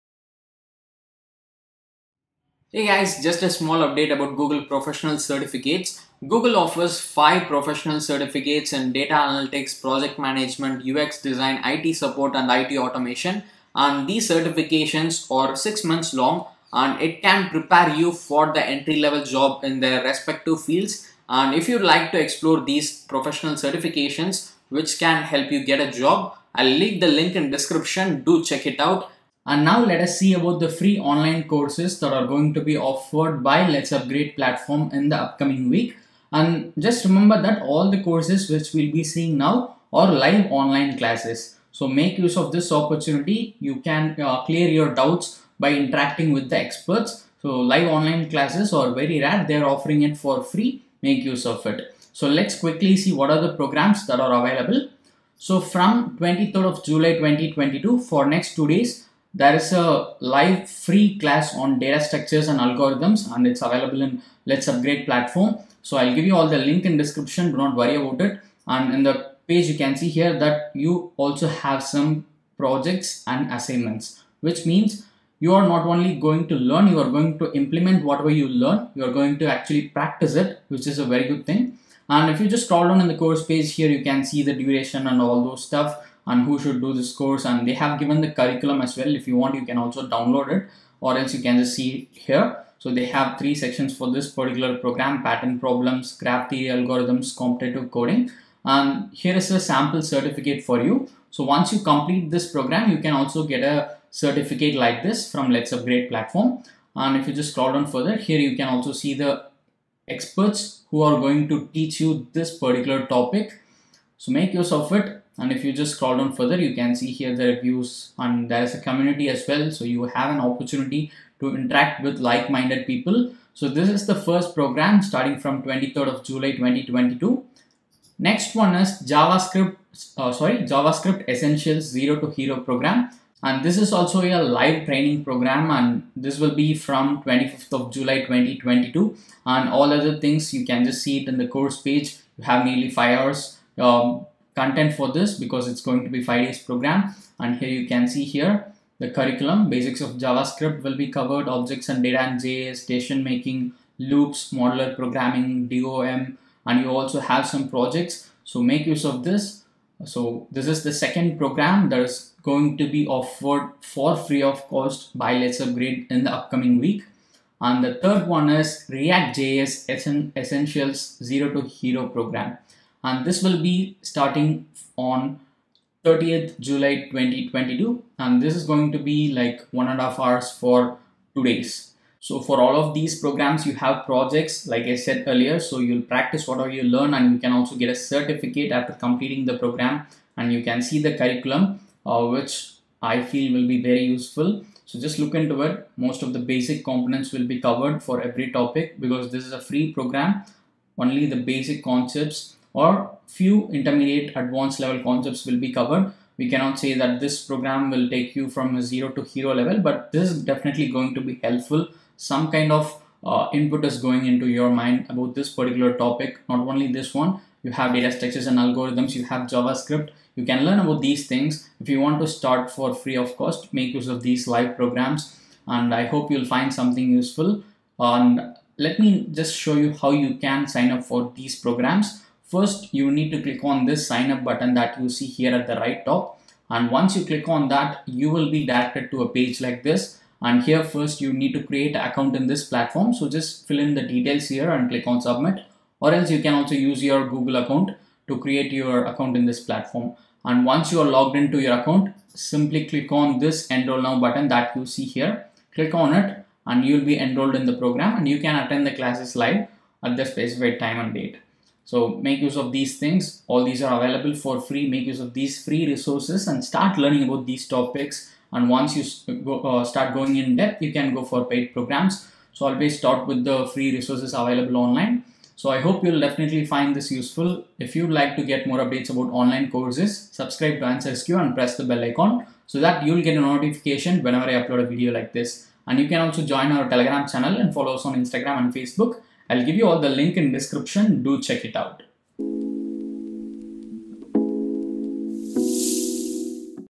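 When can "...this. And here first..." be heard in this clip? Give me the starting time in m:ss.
3:59.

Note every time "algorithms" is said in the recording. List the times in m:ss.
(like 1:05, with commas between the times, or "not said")
1:02, 1:36, 3:38.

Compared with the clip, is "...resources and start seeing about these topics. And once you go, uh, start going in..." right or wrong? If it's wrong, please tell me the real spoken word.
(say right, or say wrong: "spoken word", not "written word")
wrong: "learning", not "seeing".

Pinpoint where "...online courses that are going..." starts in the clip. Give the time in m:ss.
0:30.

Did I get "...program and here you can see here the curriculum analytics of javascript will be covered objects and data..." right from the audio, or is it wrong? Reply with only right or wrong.
wrong.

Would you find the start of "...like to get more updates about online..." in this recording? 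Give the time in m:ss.
4:38.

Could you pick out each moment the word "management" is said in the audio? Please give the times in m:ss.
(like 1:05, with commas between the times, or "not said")
0:10.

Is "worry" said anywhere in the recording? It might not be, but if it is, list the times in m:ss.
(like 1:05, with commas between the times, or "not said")
1:07.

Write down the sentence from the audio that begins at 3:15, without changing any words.
Most of the basic components will be covered for every topic because this is a free program.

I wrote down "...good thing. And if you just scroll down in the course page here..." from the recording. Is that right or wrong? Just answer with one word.
right.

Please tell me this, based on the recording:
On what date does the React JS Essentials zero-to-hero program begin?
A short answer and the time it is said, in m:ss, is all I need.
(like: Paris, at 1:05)
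30th July 2022, at 2:56.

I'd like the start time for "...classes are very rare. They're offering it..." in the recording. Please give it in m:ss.
0:48.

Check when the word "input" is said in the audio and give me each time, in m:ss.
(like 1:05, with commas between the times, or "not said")
3:33.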